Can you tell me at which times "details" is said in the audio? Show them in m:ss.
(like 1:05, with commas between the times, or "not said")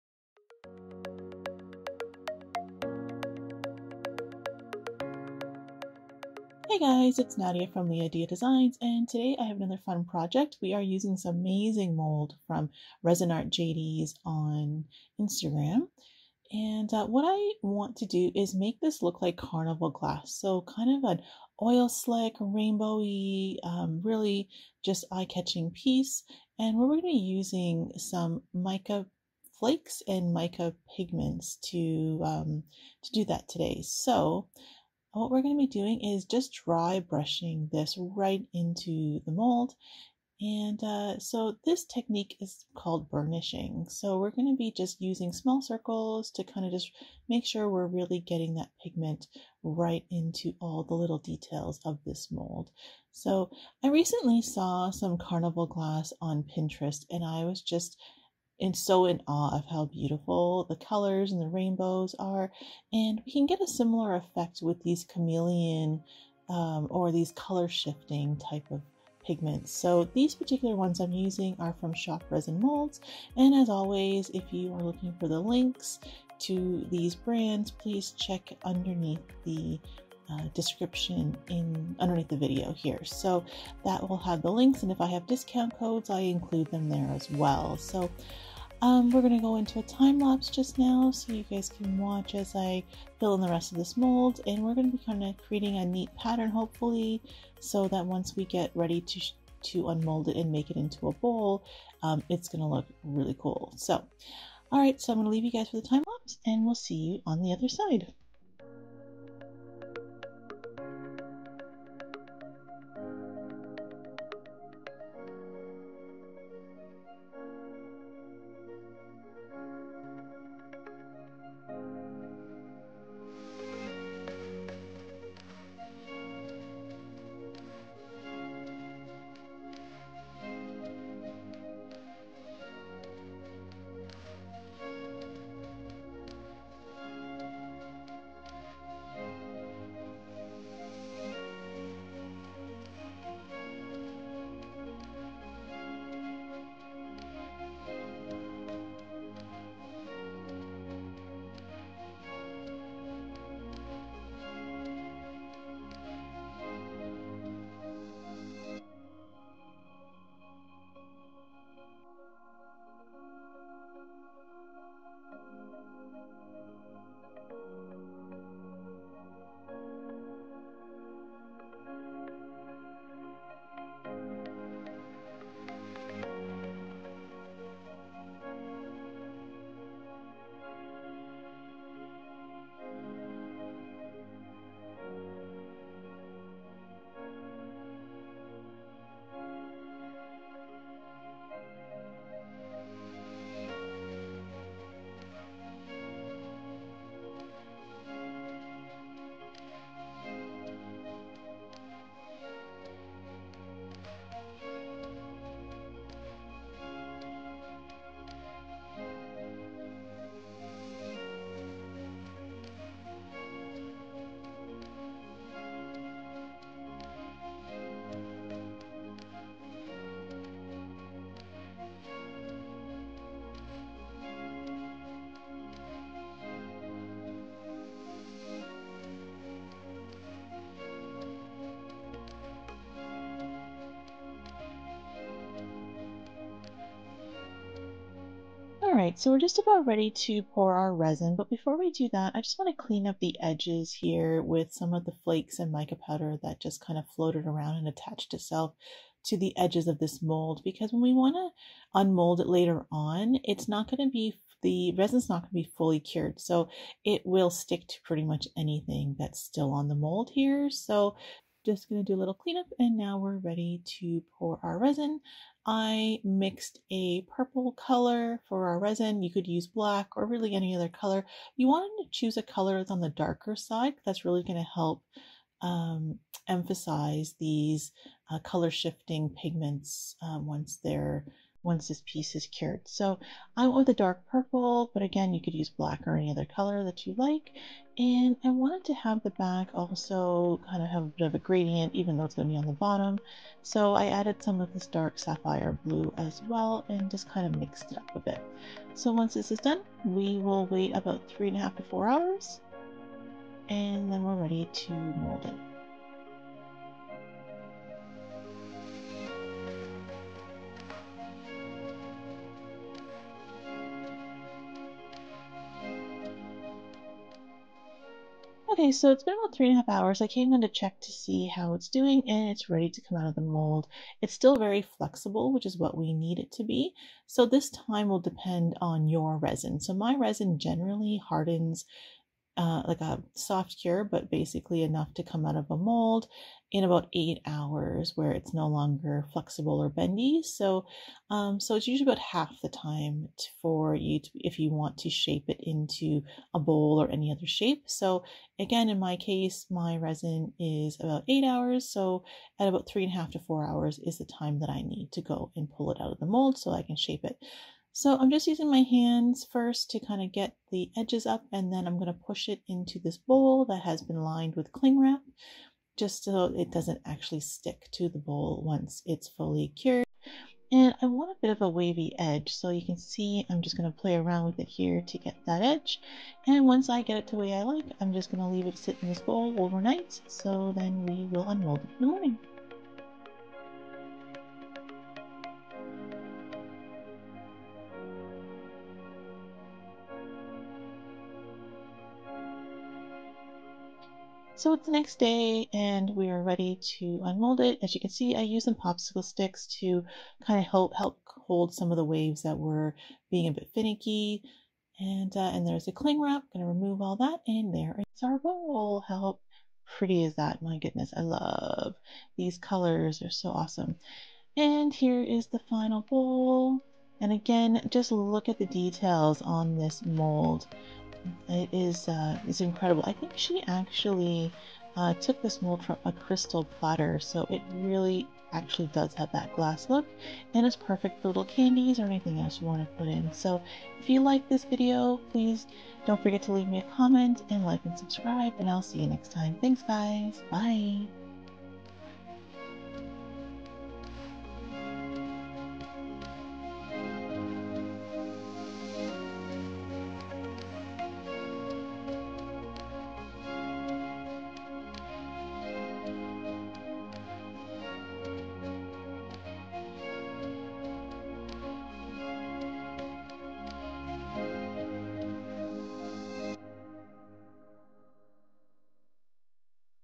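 0:51, 6:58.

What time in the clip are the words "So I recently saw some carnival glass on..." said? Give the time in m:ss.
0:53.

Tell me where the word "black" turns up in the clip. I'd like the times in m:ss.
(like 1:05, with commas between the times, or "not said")
4:29, 4:45.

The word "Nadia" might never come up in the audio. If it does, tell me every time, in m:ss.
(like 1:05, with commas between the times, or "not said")
0:07.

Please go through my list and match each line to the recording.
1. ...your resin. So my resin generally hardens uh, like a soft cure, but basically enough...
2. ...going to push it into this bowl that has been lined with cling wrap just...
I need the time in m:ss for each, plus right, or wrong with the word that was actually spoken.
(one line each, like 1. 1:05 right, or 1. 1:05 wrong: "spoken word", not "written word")
1. 5:29 right
2. 6:01 right.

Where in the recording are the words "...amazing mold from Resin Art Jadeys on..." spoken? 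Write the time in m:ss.
0:11.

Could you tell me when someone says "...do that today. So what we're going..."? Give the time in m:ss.
0:33.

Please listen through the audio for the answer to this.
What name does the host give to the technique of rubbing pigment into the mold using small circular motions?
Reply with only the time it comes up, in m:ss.
0:43.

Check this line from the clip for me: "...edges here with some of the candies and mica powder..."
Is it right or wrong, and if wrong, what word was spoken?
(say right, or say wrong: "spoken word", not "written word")
wrong: "flakes", not "candies".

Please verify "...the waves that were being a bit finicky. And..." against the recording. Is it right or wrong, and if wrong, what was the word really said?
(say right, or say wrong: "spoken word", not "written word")
right.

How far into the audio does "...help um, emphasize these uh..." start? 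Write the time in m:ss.
4:34.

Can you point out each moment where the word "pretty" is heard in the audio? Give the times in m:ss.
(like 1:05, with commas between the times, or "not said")
4:18, 6:49.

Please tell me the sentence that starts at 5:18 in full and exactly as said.
Okay, so it's been about three and a half hours.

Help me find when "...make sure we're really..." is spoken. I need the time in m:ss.
0:47.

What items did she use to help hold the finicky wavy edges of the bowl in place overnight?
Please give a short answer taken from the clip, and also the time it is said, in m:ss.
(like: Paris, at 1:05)
Popsicle sticks, at 6:38.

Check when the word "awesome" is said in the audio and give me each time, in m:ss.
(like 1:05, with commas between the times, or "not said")
6:53.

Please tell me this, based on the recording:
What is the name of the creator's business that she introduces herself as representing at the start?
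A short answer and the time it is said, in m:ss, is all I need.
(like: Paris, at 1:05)
LiaDia Designs, at 0:07.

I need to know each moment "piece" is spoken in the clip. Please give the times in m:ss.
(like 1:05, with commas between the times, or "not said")
0:25, 4:42.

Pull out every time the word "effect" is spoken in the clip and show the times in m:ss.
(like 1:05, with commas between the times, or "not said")
1:04.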